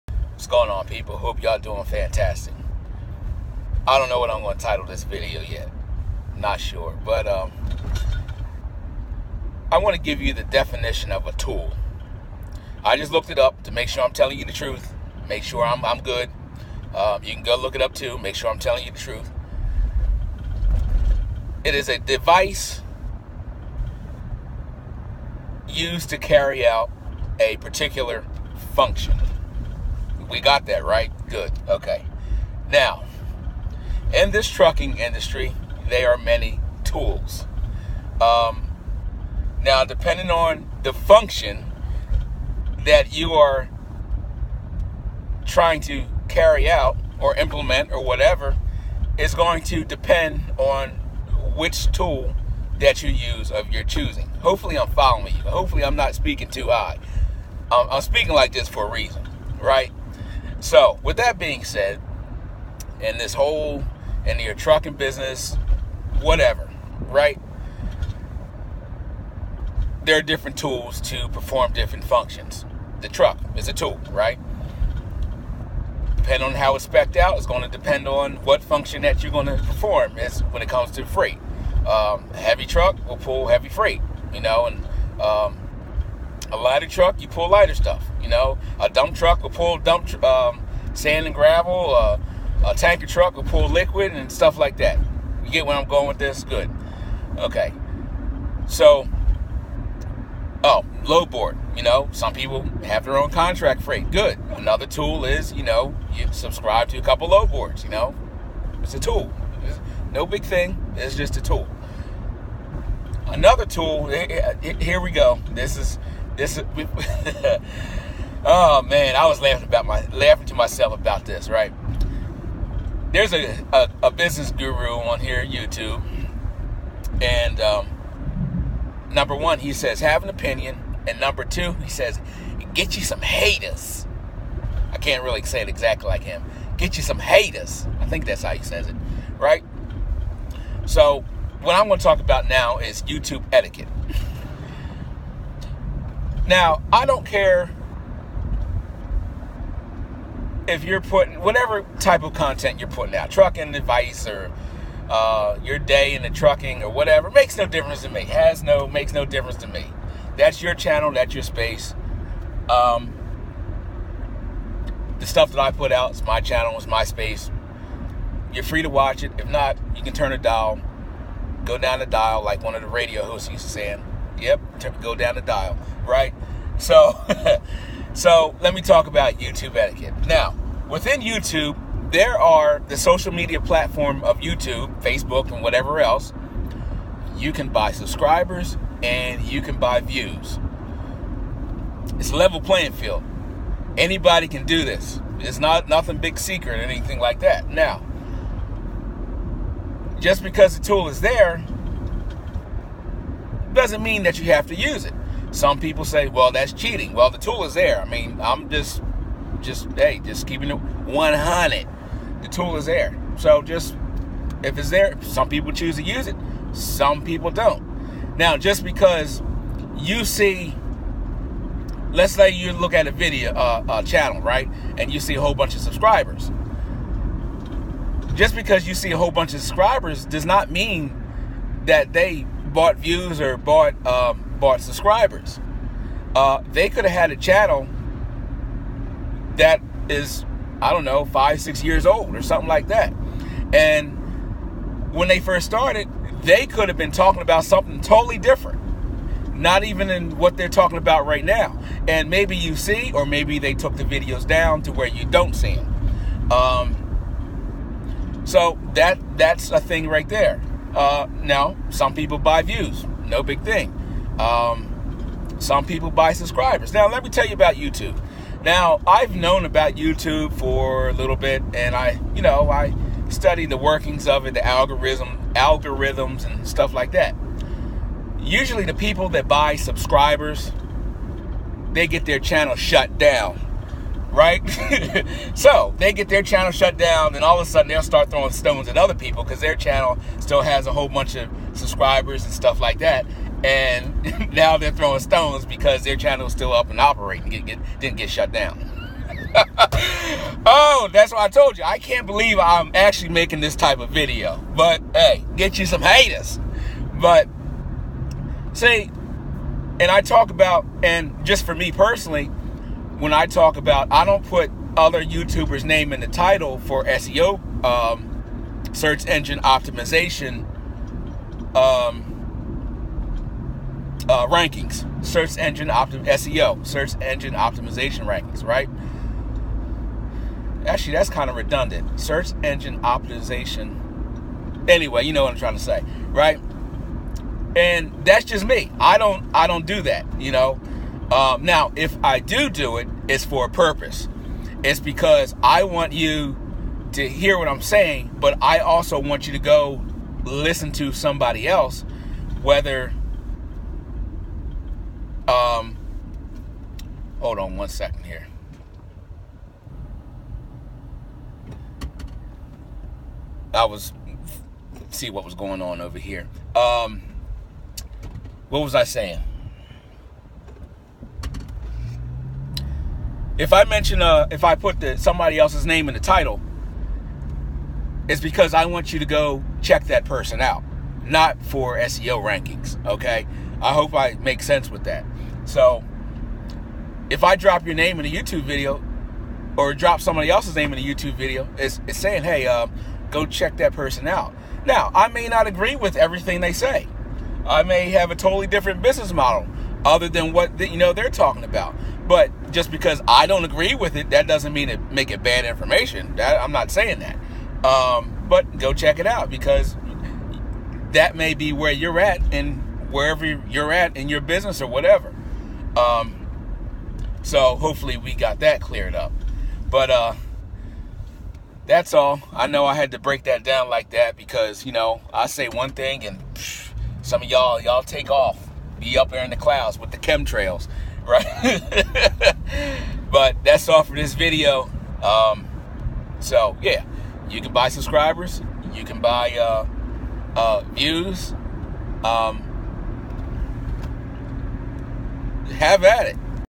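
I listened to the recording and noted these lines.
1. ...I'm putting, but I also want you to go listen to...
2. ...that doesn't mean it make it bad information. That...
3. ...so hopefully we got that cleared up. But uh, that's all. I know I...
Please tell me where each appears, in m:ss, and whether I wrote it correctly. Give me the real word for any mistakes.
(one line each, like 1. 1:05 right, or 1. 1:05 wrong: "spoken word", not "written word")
1. 5:47 wrong: "saying", not "putting"
2. 6:44 right
3. 6:57 right.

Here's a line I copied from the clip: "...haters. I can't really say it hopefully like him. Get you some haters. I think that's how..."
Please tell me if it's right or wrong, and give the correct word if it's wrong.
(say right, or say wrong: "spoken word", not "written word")
wrong: "exactly", not "hopefully".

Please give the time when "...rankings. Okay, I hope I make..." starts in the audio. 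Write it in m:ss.
6:22.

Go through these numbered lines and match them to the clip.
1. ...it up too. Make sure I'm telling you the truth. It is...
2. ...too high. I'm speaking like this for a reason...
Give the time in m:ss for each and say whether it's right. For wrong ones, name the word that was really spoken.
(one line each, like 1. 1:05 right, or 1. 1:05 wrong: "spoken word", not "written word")
1. 0:17 right
2. 0:56 right.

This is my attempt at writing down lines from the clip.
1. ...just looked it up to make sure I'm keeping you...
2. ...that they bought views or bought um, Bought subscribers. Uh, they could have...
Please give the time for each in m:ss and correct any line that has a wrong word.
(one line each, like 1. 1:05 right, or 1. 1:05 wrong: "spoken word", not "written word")
1. 0:12 wrong: "telling", not "keeping"
2. 3:51 right.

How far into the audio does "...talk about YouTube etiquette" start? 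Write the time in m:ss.
2:58.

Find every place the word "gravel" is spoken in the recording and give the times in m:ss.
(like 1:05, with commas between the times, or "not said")
1:31.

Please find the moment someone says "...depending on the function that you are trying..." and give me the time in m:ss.
0:39.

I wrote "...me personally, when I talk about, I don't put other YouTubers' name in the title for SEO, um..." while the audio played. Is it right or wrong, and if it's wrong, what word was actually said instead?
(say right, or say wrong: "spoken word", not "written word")
right.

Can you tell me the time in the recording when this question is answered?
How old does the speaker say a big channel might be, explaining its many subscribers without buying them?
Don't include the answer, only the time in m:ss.
4:01.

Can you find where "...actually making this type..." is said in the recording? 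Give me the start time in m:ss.
5:02.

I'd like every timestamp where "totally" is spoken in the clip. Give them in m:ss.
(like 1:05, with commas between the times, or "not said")
4:08, 6:38.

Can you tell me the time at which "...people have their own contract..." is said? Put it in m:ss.
1:42.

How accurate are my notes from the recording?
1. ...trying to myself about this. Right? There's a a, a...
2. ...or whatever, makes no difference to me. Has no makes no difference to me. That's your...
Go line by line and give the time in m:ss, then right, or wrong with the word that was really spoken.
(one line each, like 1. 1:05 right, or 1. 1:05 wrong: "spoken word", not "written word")
1. 2:00 wrong: "laughing", not "trying"
2. 2:36 right.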